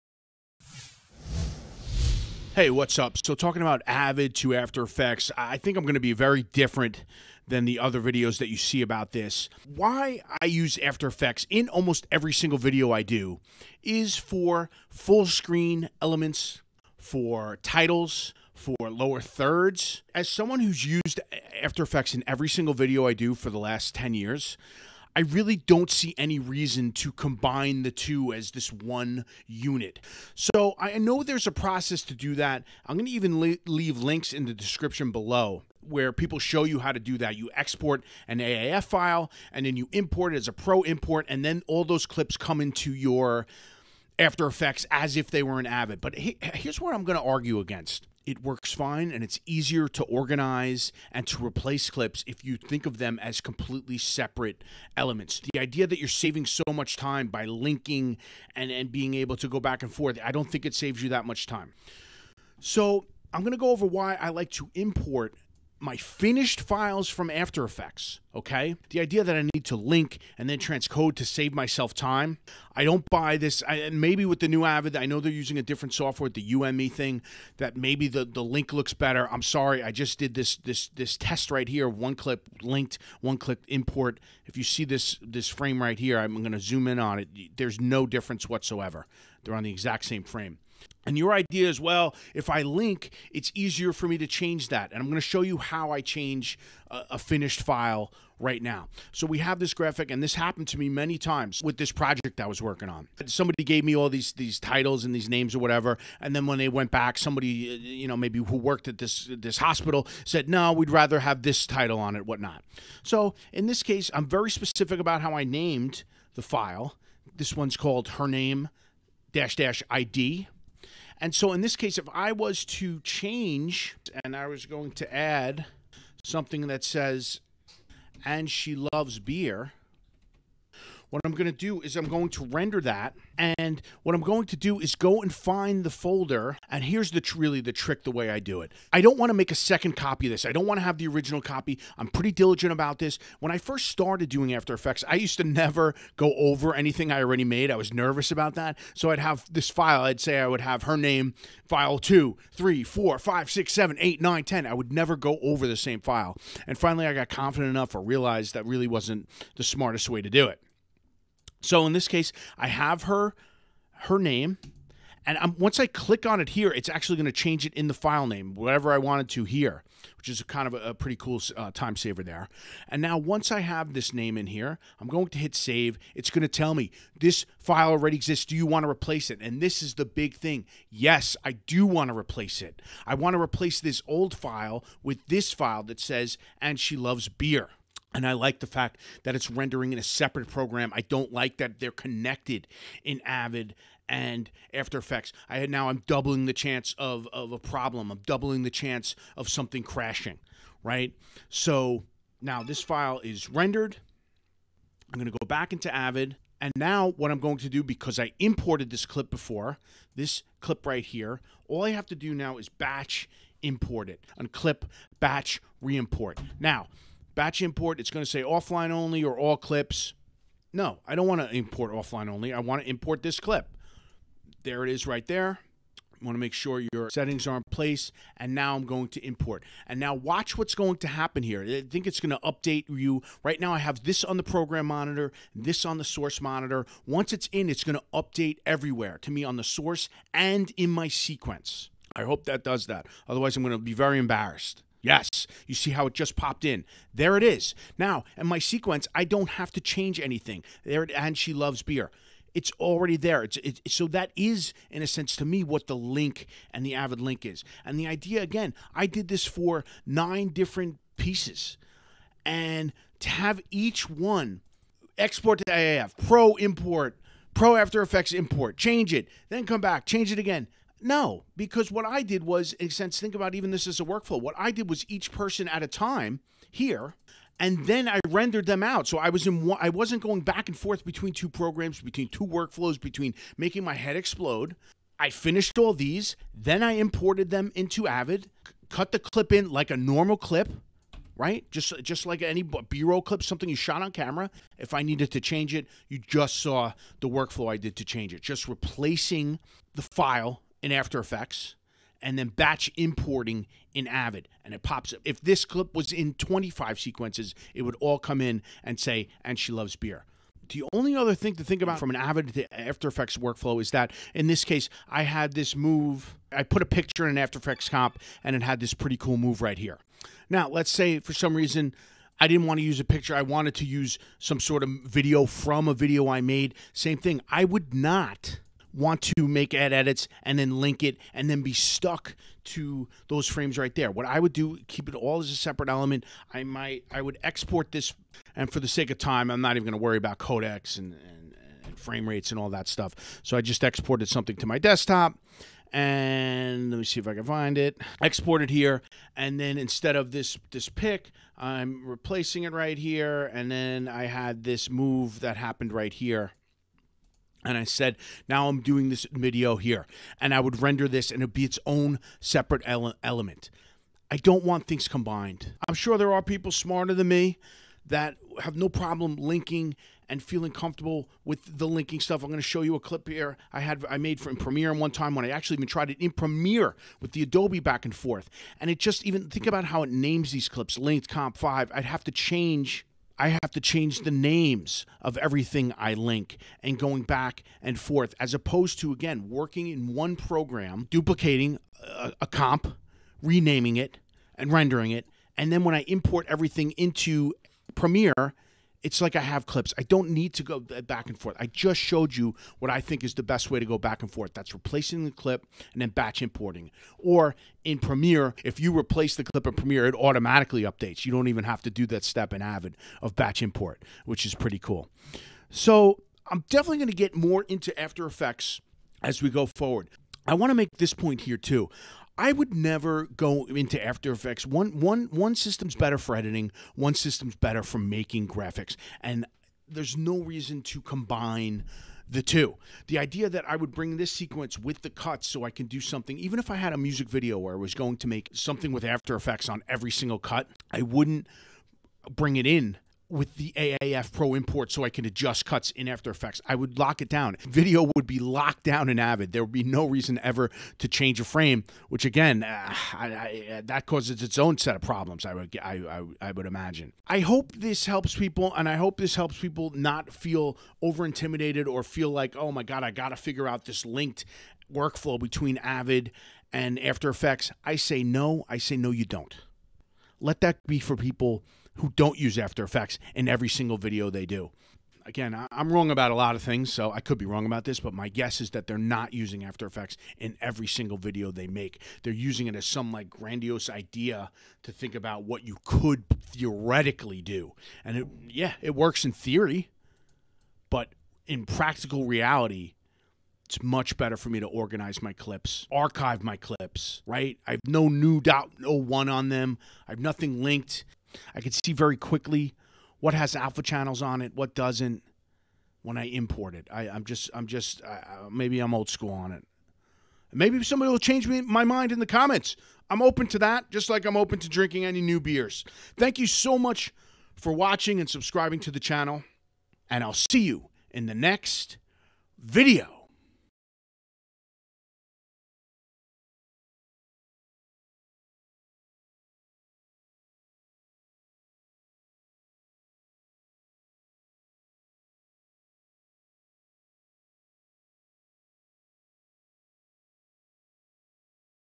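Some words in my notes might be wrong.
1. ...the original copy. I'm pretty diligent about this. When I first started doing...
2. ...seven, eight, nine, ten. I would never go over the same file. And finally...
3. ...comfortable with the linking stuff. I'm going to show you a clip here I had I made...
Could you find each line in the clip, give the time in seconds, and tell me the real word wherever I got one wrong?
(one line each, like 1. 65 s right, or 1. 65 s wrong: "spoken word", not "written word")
1. 140 s right
2. 153 s right
3. 370 s right.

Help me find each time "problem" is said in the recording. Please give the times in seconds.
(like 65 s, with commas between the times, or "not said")
197 s, 368 s, 455 s.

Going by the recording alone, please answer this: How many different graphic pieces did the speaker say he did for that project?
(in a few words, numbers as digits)
9.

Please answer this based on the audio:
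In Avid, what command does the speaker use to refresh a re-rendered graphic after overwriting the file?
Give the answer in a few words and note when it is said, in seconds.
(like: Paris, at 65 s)
batch reimport, at 215 s.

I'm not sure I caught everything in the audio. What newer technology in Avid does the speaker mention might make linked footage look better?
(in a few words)
UME.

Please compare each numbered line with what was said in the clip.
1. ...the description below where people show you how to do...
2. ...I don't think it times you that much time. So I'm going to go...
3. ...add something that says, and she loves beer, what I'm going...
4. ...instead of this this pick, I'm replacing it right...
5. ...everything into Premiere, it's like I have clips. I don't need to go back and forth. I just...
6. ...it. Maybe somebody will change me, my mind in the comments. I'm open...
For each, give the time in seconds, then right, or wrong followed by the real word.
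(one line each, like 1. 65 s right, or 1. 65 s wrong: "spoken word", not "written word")
1. 34 s right
2. 60 s wrong: "saves", not "times"
3. 125 s right
4. 349 s right
5. 396 s right
6. 509 s right.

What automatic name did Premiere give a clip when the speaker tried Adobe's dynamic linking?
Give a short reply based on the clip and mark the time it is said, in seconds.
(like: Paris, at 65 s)
linked comp 5, at 380 s.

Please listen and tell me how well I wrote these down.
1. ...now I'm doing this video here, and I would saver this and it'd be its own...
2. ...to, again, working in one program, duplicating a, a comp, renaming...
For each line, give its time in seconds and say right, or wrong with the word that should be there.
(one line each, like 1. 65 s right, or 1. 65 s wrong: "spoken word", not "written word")
1. 358 s wrong: "render", not "saver"
2. 388 s right.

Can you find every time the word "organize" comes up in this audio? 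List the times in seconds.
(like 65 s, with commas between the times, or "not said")
50 s, 494 s.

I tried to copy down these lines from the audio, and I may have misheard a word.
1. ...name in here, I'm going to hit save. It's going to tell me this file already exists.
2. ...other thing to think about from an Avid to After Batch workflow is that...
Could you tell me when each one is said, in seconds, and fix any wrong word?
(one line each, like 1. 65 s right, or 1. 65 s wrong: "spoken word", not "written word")
1. 174 s right
2. 311 s wrong: "Effects", not "Batch".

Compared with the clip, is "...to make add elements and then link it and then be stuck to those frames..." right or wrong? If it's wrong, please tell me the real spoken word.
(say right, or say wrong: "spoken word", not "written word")
wrong: "edits", not "elements".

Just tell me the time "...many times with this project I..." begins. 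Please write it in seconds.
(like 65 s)
100 s.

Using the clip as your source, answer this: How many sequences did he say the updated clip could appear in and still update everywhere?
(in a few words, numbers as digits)
25.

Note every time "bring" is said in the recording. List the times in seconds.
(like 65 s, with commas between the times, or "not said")
433 s, 442 s.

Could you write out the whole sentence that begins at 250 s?
There it, and she loves beer.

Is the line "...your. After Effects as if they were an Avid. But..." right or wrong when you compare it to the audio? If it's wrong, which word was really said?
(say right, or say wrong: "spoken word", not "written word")
right.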